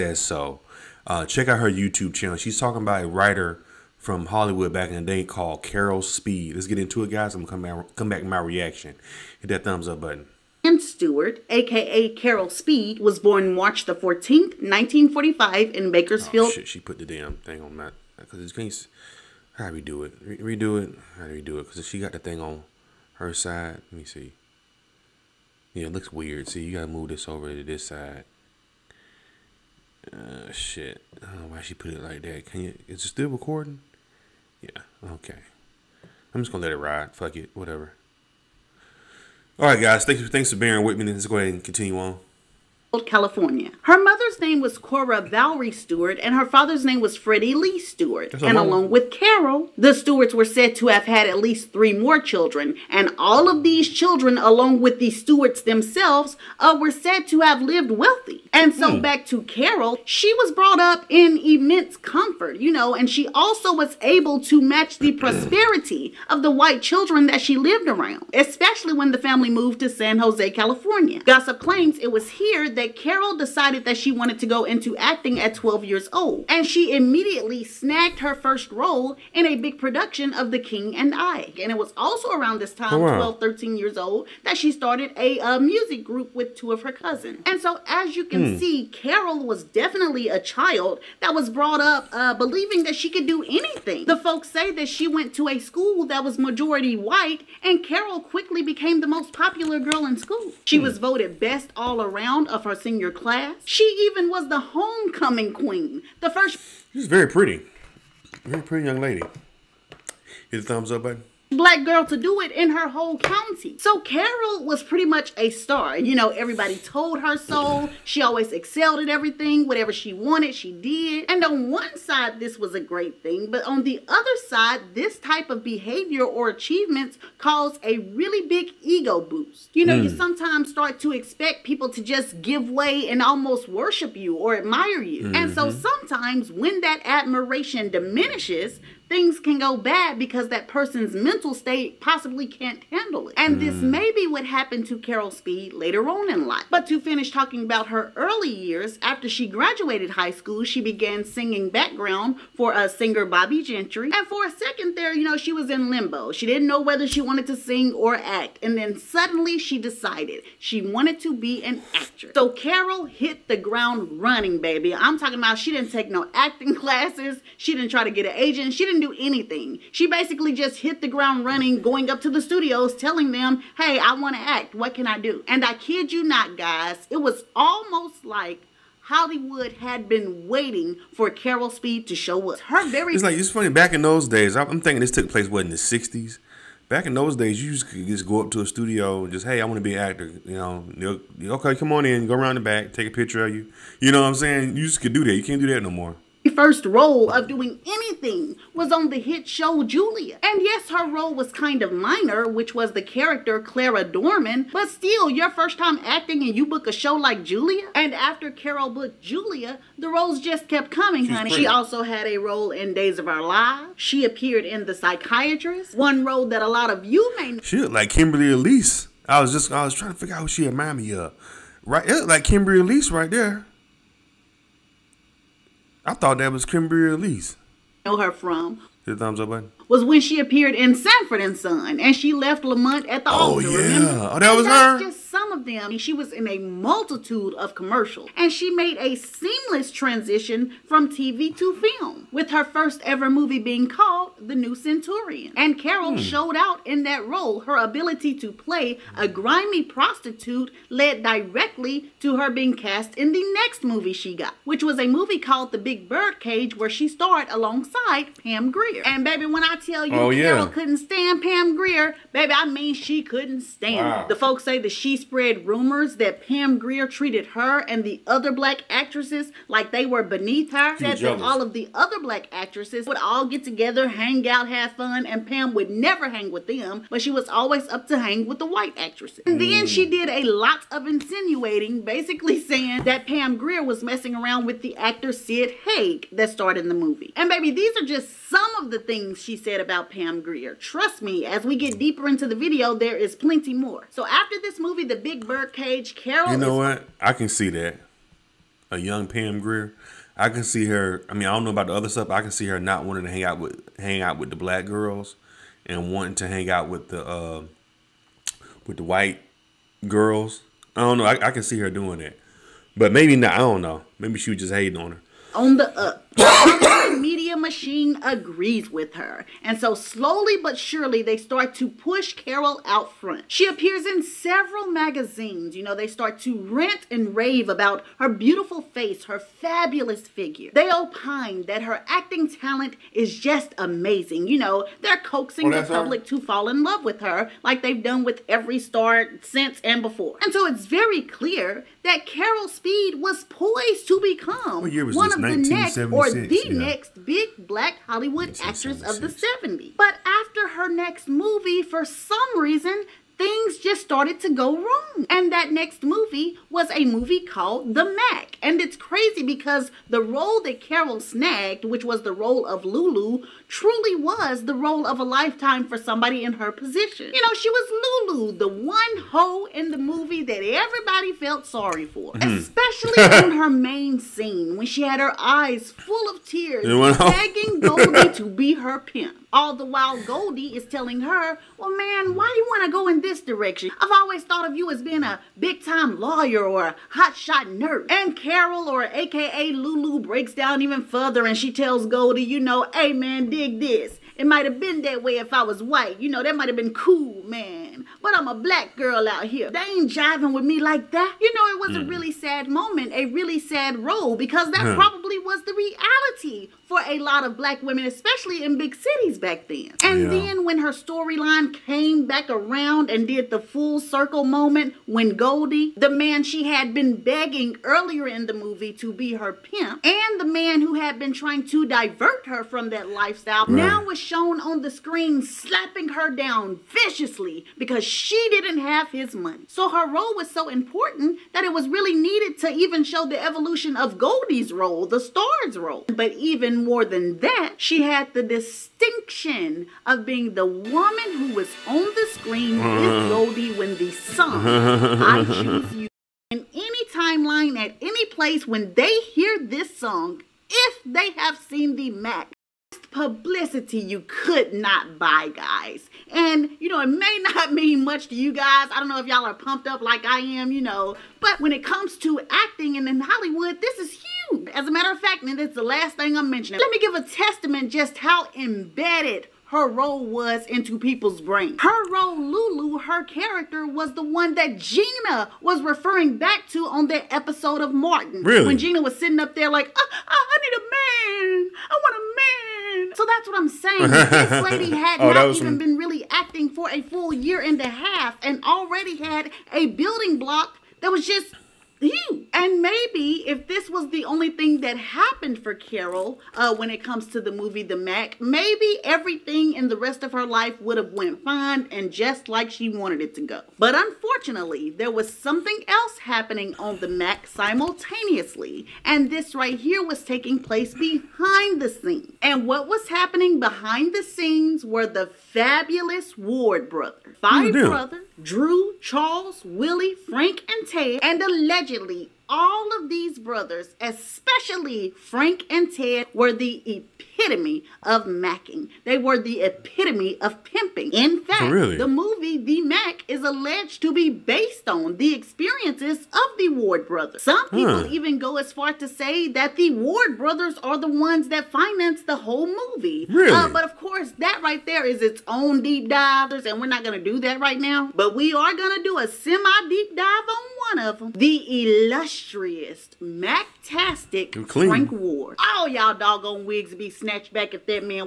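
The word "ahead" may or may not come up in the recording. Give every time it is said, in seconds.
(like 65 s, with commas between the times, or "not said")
41 s.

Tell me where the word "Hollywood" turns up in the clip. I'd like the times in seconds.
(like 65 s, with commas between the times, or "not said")
4 s, 179 s, 348 s, 463 s.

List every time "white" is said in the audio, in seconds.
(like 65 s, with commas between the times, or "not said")
66 s, 96 s, 278 s, 309 s, 395 s.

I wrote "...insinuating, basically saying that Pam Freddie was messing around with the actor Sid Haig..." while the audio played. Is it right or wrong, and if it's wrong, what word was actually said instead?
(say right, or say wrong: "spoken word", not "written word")
wrong: "Grier", not "Freddie".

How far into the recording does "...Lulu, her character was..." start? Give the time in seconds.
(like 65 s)
472 s.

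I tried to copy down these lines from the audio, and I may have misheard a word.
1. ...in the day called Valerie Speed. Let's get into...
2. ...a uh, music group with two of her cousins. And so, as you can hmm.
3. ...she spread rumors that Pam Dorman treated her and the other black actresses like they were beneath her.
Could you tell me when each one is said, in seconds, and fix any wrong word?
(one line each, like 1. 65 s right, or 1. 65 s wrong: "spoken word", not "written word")
1. 4 s wrong: "Carol", not "Valerie"
2. 85 s right
3. 264 s wrong: "Grier", not "Dorman".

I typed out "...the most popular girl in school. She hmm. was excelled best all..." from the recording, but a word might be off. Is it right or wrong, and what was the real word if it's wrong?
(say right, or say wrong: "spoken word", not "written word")
wrong: "voted", not "excelled".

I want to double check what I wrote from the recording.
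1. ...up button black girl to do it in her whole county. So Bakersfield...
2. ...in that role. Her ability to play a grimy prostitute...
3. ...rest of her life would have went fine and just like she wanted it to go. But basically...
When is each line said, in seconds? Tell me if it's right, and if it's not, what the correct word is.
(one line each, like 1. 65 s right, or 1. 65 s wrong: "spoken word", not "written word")
1. 110 s wrong: "Carol", not "Bakersfield"
2. 246 s right
3. 499 s wrong: "unfortunately", not "basically".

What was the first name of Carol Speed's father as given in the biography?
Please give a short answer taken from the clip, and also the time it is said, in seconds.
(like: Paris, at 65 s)
Freddie Lee, at 47 s.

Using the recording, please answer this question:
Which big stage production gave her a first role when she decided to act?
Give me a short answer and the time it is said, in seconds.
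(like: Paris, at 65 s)
The King and I, at 80 s.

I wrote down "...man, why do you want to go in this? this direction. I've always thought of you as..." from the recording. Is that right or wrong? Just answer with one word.
right.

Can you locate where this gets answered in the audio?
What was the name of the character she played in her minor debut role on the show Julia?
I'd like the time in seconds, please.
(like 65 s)
203 s.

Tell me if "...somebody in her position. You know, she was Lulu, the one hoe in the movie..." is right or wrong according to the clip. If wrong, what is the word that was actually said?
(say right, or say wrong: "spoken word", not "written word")
right.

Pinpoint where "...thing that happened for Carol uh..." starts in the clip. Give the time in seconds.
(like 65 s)
494 s.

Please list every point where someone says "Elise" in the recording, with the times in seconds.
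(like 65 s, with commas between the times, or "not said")
218 s, 222 s, 227 s.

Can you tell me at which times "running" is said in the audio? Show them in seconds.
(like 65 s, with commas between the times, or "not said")
164 s, 171 s.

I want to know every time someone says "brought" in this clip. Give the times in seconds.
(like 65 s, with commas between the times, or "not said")
60 s, 91 s.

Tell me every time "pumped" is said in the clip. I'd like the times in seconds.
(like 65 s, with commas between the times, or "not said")
459 s.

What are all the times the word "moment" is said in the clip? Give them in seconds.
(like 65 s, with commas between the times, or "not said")
402 s, 414 s.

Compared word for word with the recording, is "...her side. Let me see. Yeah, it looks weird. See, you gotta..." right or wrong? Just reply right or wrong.
right.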